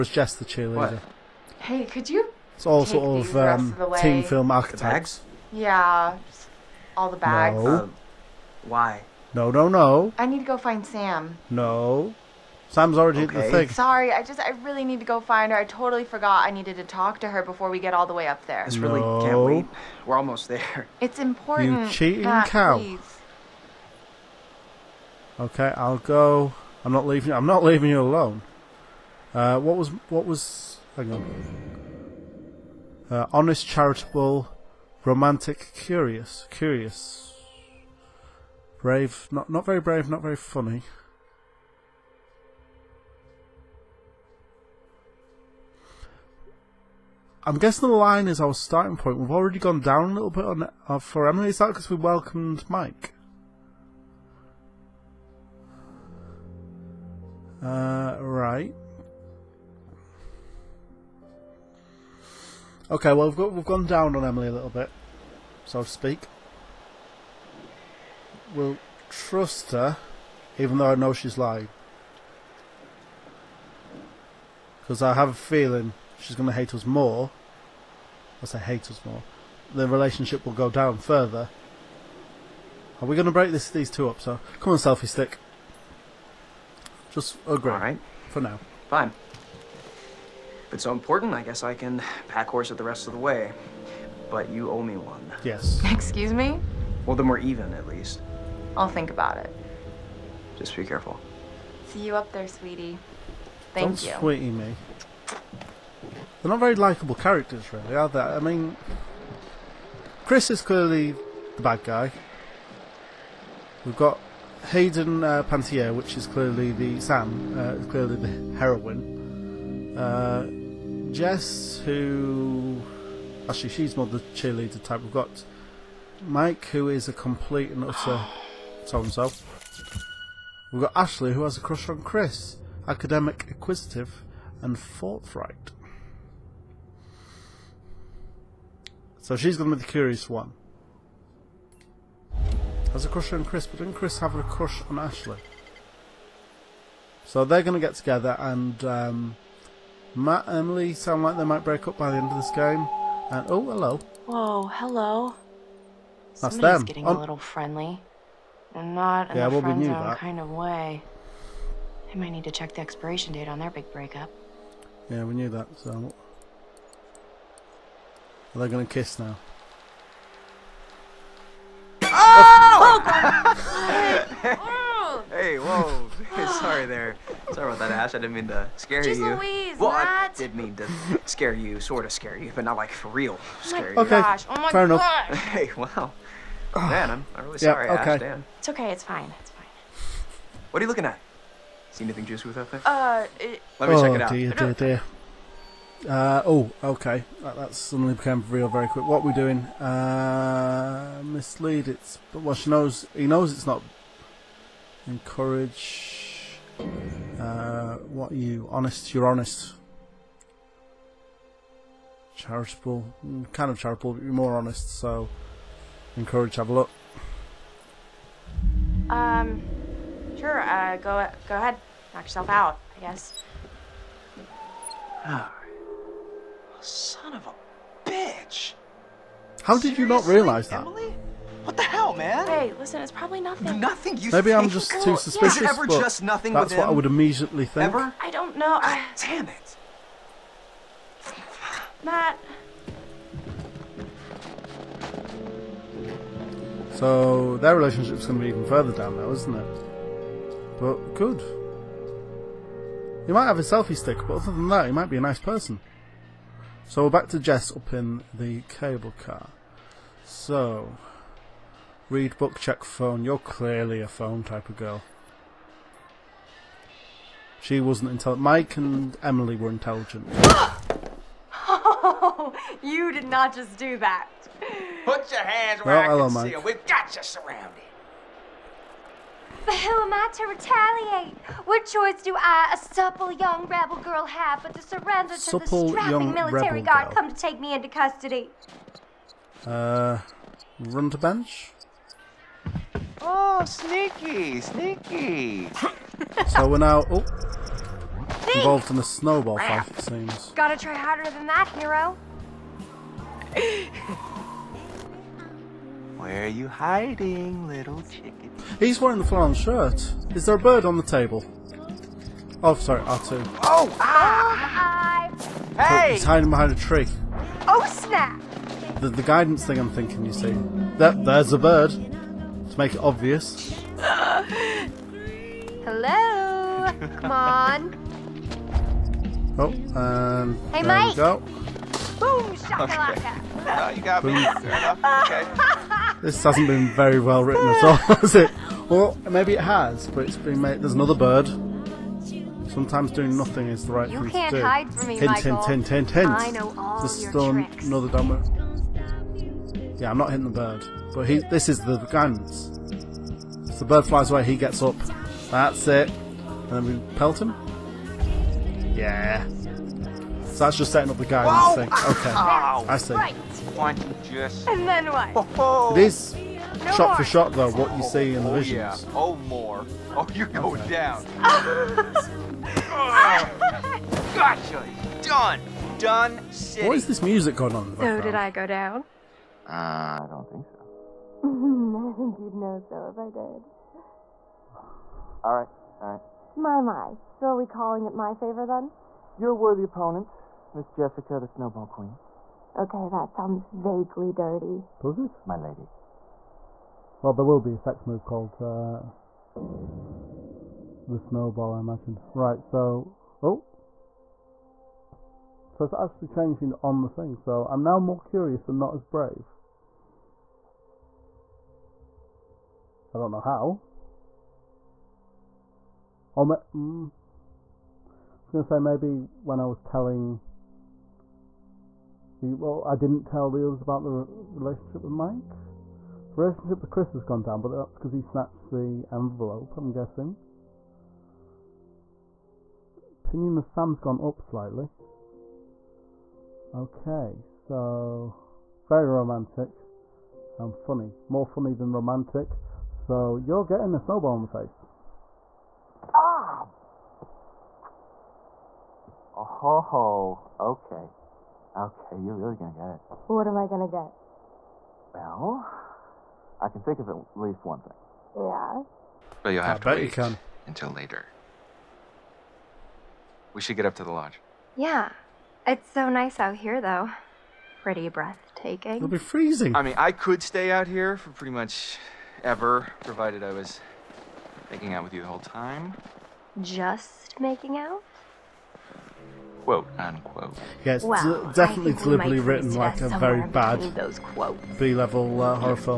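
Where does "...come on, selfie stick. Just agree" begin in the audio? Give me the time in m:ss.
1:24.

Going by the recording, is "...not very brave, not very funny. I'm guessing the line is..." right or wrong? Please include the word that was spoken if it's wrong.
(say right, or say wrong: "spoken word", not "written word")
right.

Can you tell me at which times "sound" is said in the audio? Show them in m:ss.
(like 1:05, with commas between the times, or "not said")
2:30, 6:33.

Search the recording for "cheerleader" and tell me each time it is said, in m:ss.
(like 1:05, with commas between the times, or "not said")
0:00, 2:04.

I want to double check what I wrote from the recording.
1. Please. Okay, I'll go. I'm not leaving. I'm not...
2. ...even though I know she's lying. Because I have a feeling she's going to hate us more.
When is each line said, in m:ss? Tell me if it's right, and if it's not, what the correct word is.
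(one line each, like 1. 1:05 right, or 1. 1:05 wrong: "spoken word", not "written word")
1. 0:22 right
2. 1:10 right.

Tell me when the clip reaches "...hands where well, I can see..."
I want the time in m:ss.
4:35.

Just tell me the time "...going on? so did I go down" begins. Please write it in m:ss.
6:17.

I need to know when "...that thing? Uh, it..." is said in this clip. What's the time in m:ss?
3:12.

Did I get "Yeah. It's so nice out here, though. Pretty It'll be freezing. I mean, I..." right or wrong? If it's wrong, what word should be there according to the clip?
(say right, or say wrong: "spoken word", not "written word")
right.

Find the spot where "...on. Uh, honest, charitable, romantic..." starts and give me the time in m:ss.
0:31.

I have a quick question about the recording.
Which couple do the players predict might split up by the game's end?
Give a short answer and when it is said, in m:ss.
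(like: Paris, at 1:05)
Matt and Emily, at 2:30.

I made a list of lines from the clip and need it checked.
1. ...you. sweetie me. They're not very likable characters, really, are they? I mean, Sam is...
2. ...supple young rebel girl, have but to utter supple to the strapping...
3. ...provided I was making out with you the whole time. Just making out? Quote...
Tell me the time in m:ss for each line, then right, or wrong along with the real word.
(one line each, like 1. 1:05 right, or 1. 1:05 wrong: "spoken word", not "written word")
1. 1:44 wrong: "Chris", not "Sam"
2. 4:42 wrong: "surrender", not "utter"
3. 7:53 right.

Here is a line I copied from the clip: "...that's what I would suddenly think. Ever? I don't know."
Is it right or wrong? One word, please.
wrong.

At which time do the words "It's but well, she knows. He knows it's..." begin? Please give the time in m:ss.
3:21.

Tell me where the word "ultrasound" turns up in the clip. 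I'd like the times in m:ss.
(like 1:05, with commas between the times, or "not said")
not said.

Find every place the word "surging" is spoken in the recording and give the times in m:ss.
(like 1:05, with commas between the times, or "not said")
not said.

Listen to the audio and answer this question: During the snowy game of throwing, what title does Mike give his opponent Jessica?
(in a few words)
the Snowball Queen.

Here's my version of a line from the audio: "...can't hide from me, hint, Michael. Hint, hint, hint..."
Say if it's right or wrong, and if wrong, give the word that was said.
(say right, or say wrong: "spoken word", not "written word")
right.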